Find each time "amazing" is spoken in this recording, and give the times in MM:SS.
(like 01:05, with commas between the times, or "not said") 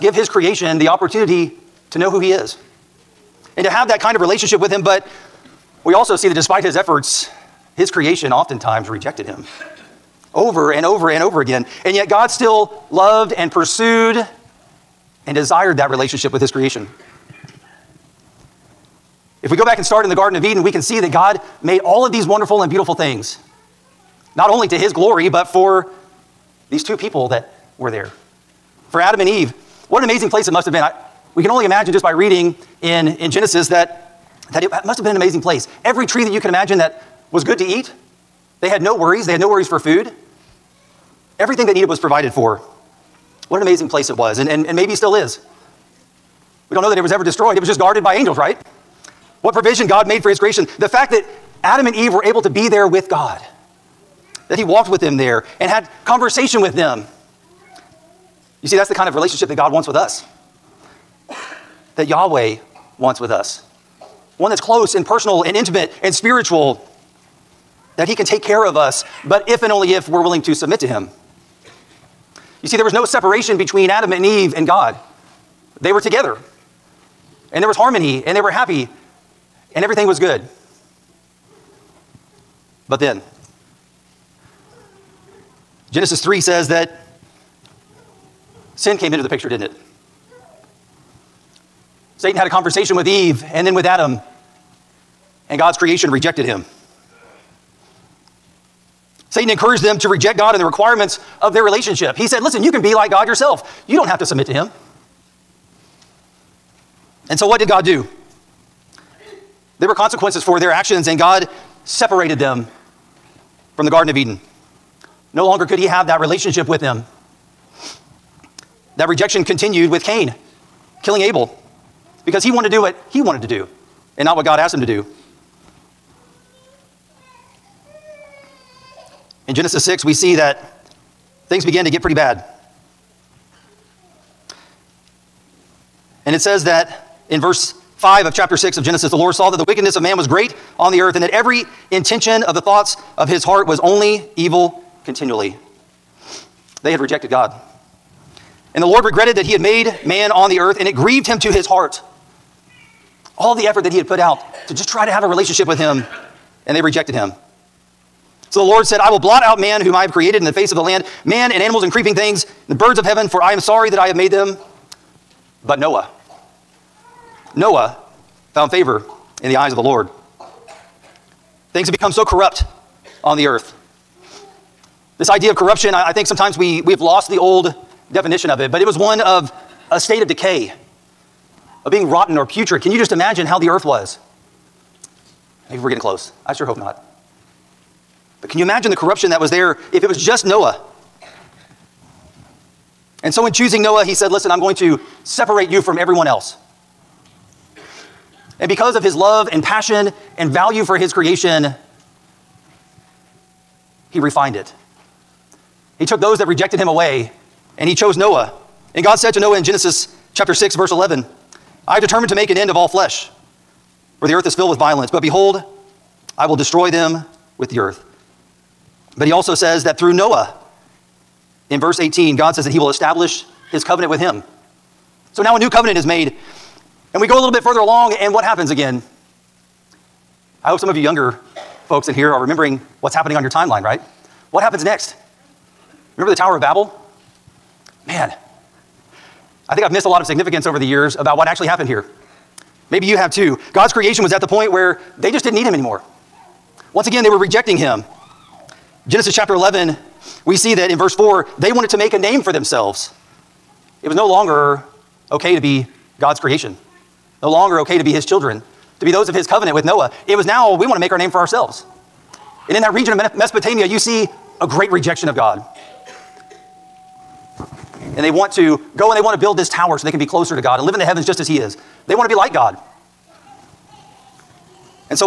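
00:30, 00:35, 00:43.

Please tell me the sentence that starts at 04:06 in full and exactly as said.
Once again, they were rejecting him.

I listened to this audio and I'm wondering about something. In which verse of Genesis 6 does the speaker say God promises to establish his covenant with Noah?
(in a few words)
Verse 18.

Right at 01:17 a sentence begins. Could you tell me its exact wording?
And there was harmony, and they were happy, and everything was good.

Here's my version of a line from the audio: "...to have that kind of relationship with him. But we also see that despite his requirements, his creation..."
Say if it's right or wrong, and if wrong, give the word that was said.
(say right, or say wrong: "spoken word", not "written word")
wrong: "efforts", not "requirements".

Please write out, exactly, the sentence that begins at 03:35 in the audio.
But behold, I will destroy them with the earth.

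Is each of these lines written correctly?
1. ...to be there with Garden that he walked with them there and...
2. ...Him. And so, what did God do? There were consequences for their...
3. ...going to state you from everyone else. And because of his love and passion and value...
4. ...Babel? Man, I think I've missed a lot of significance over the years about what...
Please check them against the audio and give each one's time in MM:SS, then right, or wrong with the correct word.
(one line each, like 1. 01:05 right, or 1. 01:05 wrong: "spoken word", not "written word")
1. 00:52 wrong: "God", not "Garden"
2. 01:44 right
3. 03:14 wrong: "separate", not "state"
4. 03:56 right.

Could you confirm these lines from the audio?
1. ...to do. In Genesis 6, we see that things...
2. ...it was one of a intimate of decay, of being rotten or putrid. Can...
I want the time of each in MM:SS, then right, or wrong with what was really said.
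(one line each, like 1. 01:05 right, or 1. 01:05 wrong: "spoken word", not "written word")
1. 02:04 right
2. 02:58 wrong: "state", not "intimate".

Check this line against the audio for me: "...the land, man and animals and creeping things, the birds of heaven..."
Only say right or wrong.
right.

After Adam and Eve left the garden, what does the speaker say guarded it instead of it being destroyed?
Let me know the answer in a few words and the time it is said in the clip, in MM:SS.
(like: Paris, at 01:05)
Angels, at 00:48.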